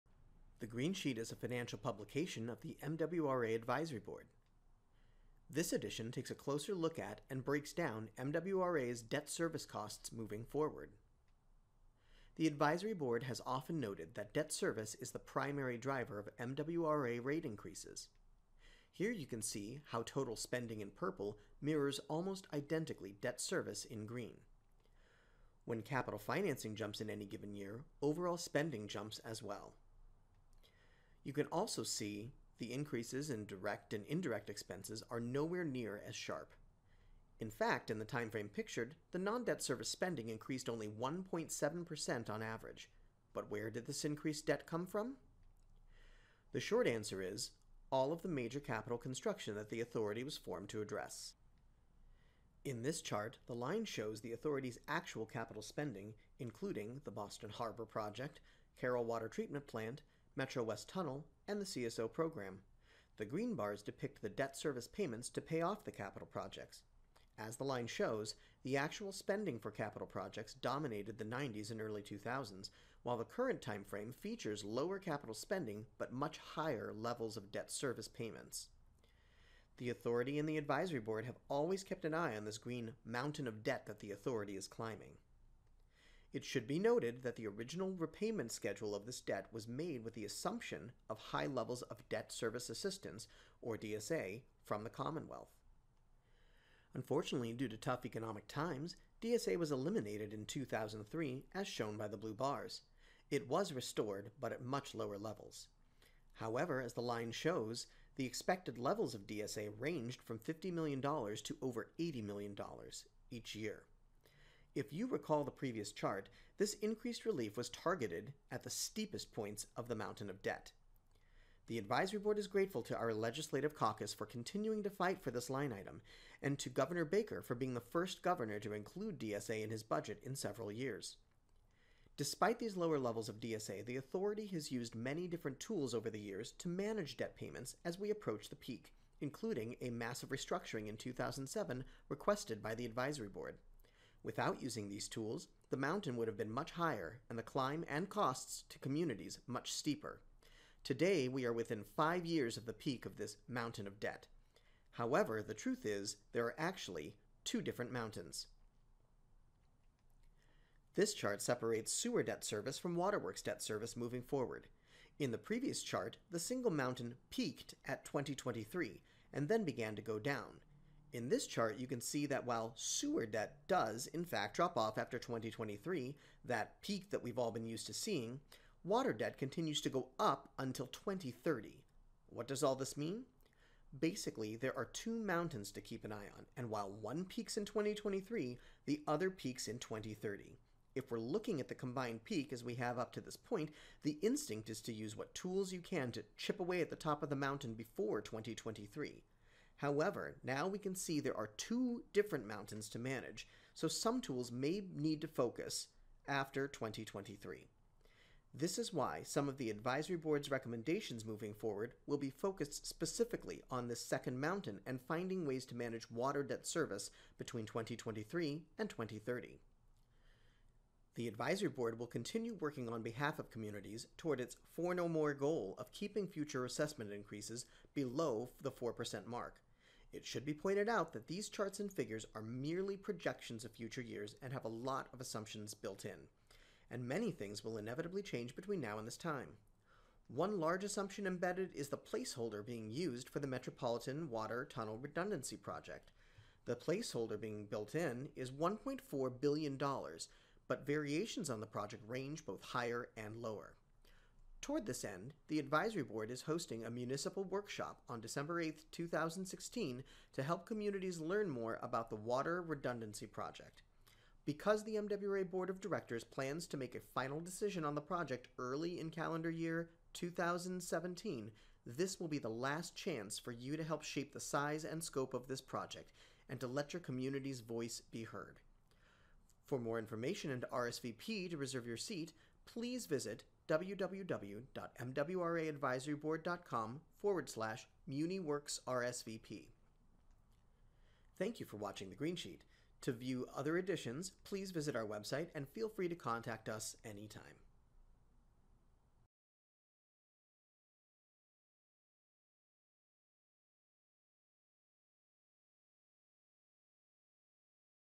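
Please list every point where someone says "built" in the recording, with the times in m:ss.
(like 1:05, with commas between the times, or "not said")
3:55, 4:07.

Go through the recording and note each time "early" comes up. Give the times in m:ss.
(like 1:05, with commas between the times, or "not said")
1:11, 4:28.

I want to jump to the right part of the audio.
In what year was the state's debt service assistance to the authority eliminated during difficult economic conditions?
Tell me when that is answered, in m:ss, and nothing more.
1:40.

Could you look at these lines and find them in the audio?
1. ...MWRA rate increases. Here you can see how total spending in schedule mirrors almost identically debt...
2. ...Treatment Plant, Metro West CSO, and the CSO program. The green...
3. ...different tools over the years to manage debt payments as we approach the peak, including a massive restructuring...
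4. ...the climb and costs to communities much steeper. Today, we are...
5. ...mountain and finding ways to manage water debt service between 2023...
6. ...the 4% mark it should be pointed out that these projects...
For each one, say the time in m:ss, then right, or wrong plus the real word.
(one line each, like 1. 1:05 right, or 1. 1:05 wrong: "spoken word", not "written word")
1. 0:16 wrong: "purple", not "schedule"
2. 0:59 wrong: "Tunnel", not "CSO"
3. 2:15 right
4. 2:27 right
5. 3:34 right
6. 3:48 wrong: "charts", not "projects".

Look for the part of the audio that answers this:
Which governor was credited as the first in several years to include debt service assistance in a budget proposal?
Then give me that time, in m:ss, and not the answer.
2:06.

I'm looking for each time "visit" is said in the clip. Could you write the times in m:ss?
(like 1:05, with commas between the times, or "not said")
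4:43, 4:54.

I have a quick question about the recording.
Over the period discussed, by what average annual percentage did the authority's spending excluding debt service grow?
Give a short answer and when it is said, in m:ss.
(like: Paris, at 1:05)
1.7%, at 0:40.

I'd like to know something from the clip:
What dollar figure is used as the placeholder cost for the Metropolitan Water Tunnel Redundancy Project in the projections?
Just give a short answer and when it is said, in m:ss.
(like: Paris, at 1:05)
$1.4 billion, at 4:08.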